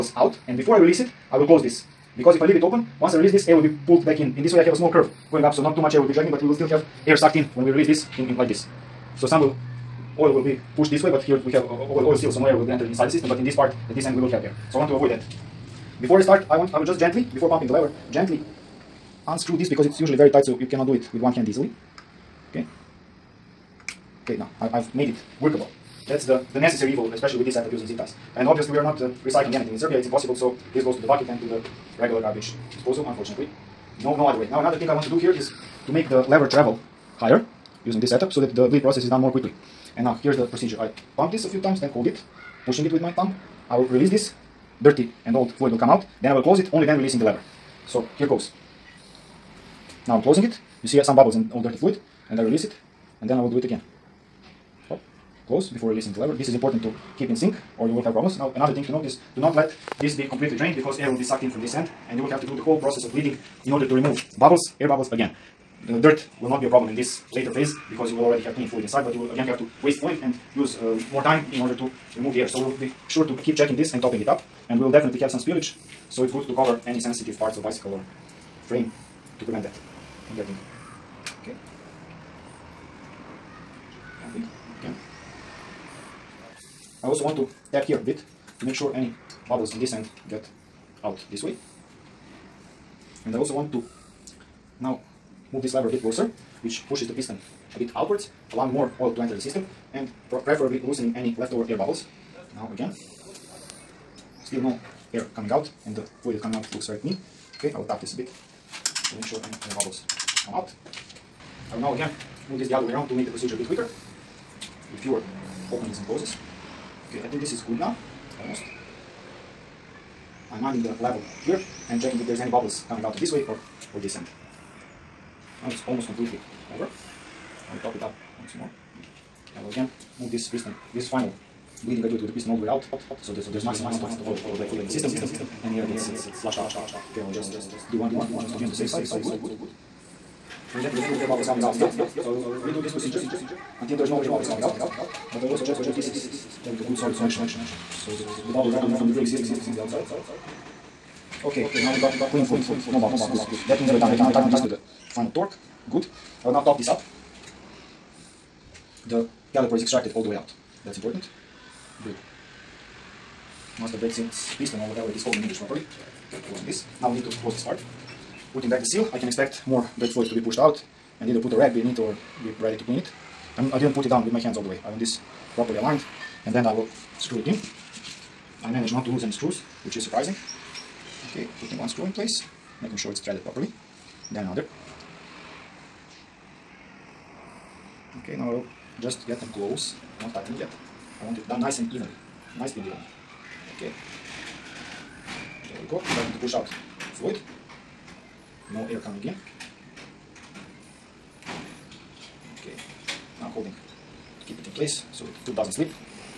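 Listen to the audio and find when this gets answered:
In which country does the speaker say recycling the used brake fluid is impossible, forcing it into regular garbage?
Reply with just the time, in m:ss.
0:29.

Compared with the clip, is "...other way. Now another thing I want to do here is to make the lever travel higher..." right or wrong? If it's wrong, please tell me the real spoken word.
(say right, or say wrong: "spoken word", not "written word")
right.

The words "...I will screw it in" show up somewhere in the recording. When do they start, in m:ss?
2:56.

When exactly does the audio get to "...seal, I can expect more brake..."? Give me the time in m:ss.
2:48.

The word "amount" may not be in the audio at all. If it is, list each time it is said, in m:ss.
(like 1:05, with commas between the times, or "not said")
2:13.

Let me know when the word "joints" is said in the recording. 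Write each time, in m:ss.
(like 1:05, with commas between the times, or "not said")
not said.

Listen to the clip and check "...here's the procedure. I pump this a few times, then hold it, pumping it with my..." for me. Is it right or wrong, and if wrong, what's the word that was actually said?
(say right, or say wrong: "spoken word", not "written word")
wrong: "pushing", not "pumping".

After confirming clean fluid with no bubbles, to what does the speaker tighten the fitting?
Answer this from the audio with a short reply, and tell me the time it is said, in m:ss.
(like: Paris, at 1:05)
final torque, at 2:35.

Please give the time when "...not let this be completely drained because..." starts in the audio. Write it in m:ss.
0:59.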